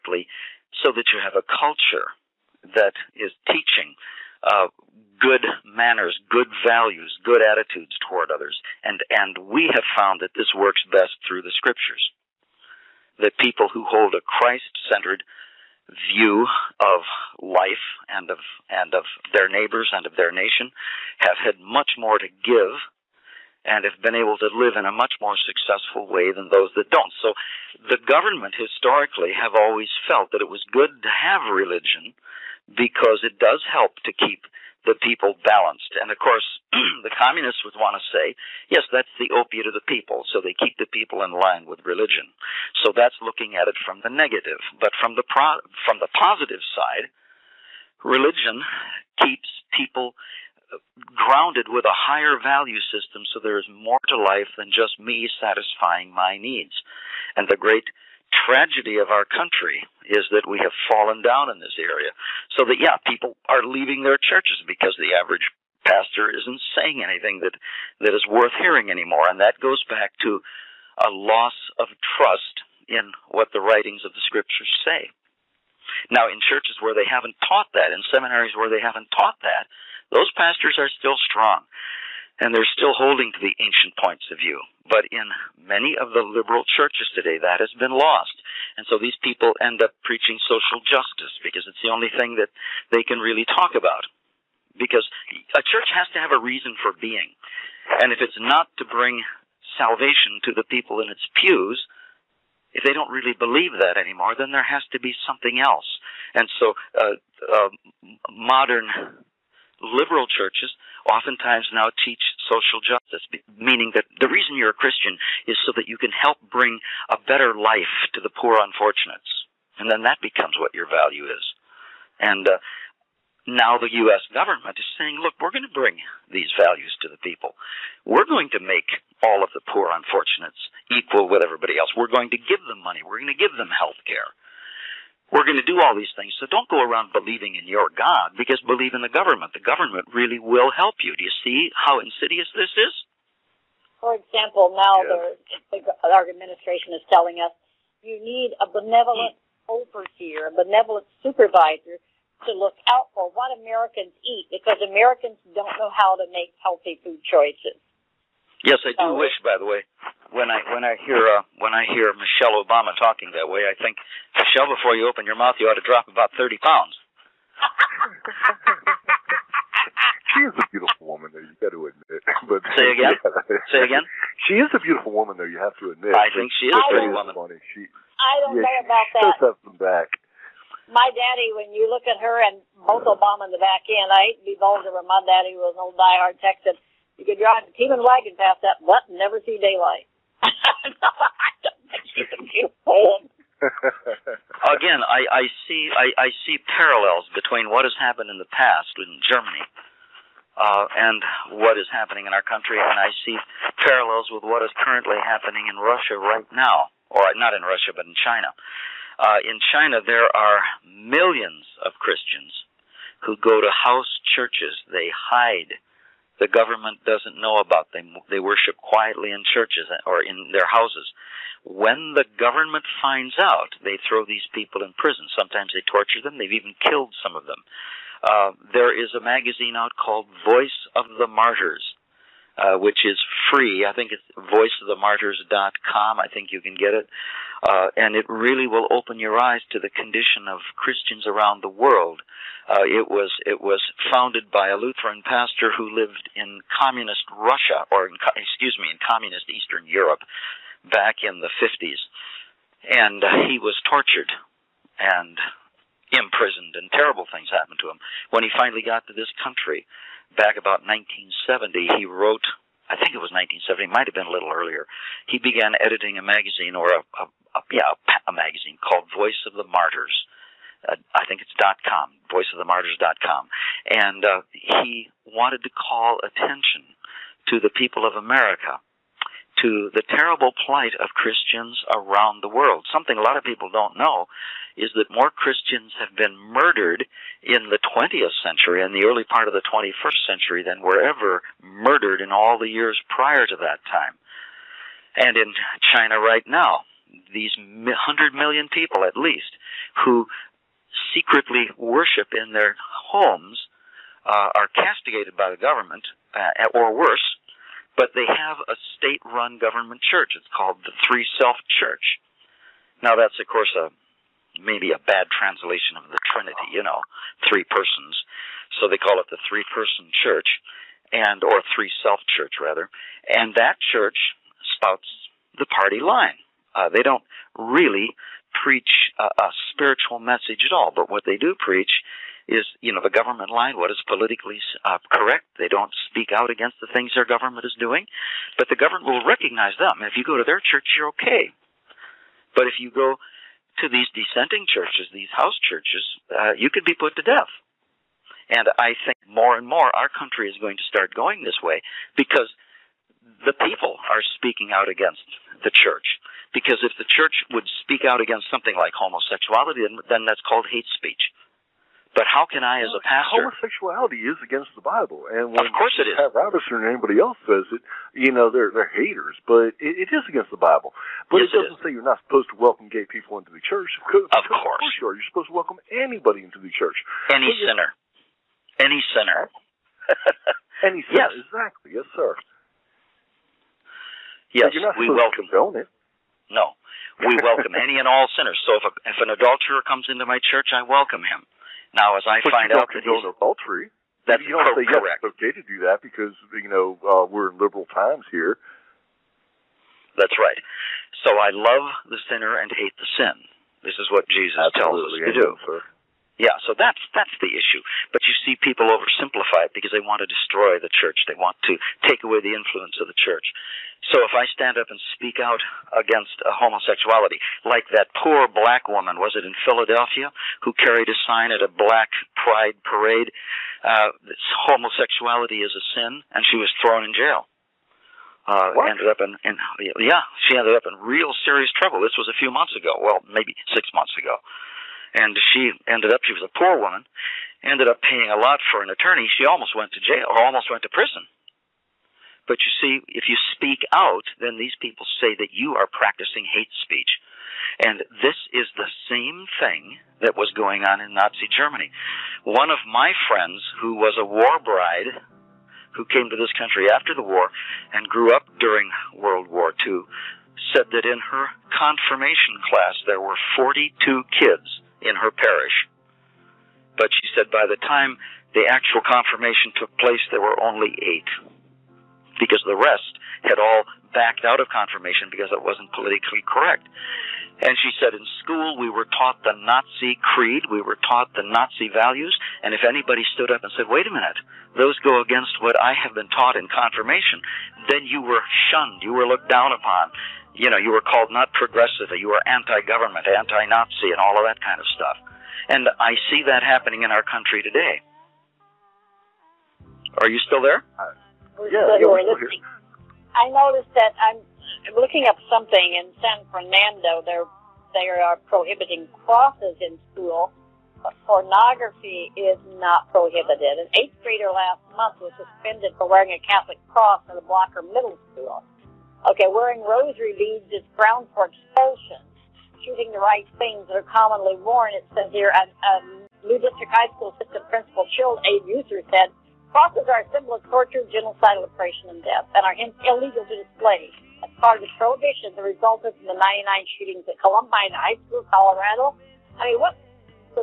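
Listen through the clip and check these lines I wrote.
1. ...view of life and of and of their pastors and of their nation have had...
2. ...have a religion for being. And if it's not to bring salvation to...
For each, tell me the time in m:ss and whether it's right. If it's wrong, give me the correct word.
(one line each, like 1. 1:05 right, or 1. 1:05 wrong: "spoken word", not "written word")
1. 0:16 wrong: "neighbors", not "pastors"
2. 1:36 wrong: "reason", not "religion".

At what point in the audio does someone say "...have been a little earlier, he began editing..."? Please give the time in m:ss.
4:24.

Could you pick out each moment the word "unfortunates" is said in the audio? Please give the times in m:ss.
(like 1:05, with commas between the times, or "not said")
1:58, 2:09.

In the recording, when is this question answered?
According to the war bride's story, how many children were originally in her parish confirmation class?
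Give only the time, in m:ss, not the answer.
7:43.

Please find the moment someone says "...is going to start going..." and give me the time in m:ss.
5:50.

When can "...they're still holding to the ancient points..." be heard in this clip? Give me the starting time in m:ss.
1:22.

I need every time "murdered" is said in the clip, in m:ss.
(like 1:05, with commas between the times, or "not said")
4:46, 4:51.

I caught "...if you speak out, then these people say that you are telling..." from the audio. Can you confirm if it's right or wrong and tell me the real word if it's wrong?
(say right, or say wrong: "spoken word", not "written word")
wrong: "practicing", not "telling".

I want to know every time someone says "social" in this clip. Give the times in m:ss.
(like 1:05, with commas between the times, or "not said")
1:30, 1:52.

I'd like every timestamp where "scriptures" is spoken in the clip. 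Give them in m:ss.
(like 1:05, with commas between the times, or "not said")
0:11, 1:14.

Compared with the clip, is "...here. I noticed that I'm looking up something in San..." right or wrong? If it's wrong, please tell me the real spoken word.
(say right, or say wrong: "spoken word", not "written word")
right.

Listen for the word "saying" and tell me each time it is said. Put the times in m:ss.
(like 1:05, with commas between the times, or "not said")
1:06, 2:04.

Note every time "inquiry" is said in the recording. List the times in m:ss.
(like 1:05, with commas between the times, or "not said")
not said.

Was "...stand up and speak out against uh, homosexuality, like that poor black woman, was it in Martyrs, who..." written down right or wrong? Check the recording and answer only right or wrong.
wrong.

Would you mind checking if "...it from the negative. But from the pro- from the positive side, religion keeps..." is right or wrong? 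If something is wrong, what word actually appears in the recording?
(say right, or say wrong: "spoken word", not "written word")
right.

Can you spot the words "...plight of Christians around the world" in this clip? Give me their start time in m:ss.
4:40.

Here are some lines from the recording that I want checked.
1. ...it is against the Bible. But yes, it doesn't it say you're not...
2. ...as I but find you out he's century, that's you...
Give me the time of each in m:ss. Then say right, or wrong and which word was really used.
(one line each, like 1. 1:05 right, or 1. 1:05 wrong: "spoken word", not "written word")
1. 6:10 right
2. 6:32 wrong: "adultery", not "century".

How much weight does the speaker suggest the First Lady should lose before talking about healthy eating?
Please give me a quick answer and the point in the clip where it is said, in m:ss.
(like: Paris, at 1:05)
30 pounds, at 2:46.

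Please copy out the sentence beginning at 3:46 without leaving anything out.
They've even killed some of them.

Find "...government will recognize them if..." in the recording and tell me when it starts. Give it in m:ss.
5:38.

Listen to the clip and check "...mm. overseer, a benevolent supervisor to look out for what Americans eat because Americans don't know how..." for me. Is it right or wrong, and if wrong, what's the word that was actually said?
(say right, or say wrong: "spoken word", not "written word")
right.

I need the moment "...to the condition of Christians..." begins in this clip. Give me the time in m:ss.
3:59.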